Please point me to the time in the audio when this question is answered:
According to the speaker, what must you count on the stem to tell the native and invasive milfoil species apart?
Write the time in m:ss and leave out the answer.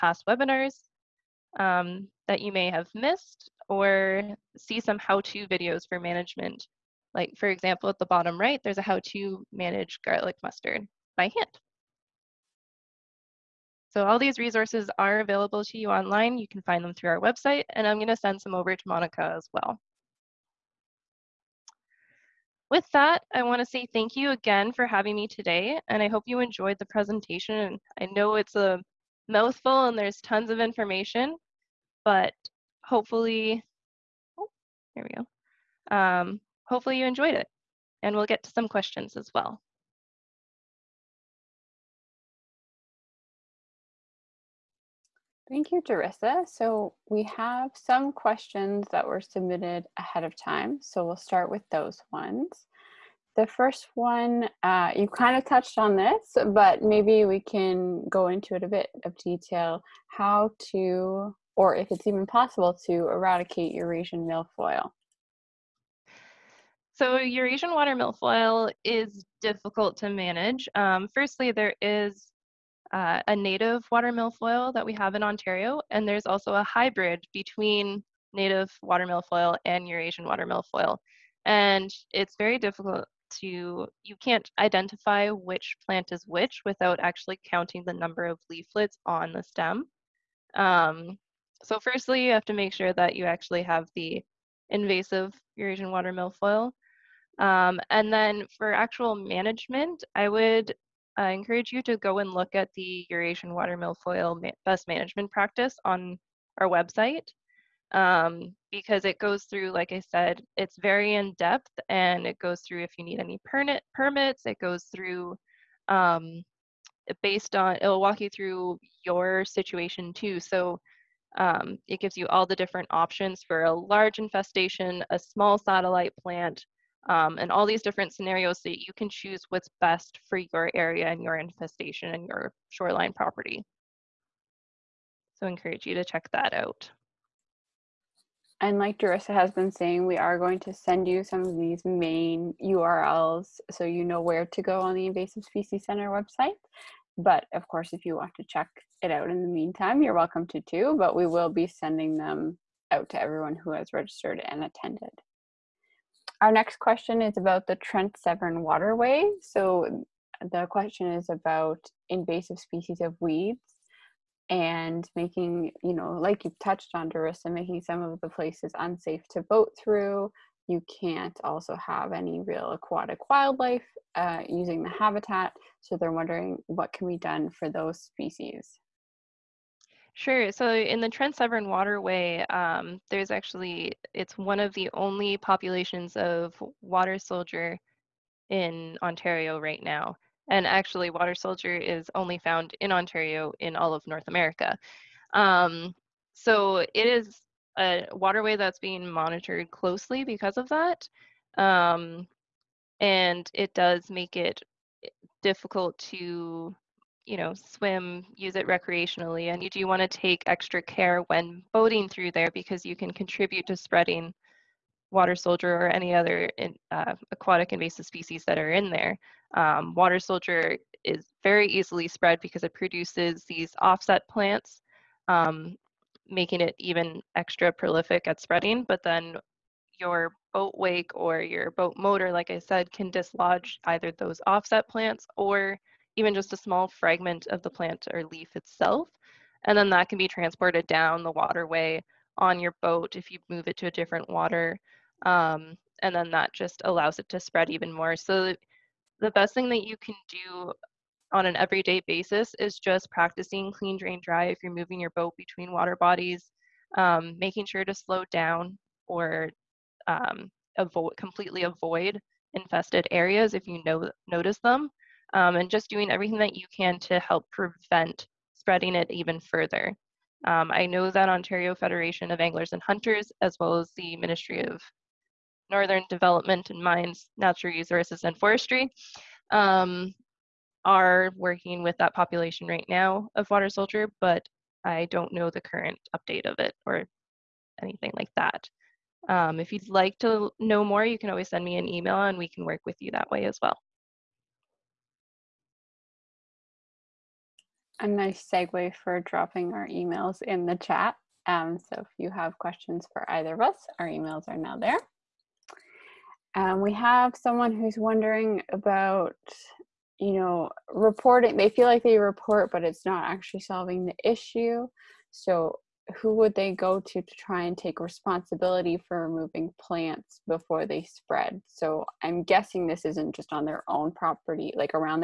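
1:28.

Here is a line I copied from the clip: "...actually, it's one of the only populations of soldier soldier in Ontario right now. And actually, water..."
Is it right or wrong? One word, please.
wrong.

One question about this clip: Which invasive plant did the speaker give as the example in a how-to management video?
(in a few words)
Garlic mustard.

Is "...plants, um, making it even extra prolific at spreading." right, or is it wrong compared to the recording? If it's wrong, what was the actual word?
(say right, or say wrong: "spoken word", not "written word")
right.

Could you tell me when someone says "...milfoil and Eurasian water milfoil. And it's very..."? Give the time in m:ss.
1:19.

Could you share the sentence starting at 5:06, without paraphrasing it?
Um, we have someone who's wondering about, you know, reporting.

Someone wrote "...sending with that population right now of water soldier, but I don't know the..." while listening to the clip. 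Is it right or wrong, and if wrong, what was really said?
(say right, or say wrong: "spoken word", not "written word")
wrong: "working", not "sending".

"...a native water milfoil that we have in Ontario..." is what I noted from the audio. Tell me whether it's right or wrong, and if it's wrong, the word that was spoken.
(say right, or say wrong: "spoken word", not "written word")
right.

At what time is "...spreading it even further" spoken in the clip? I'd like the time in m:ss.
4:28.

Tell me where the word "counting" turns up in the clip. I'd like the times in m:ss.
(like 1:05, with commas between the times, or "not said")
1:27.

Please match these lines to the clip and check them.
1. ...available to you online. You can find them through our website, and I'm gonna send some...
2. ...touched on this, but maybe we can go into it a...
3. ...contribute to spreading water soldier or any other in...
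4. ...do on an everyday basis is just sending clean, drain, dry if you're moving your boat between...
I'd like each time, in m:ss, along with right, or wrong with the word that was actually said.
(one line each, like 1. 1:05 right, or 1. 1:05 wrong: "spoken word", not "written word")
1. 0:15 right
2. 0:55 right
3. 3:33 right
4. 4:10 wrong: "practicing", not "sending".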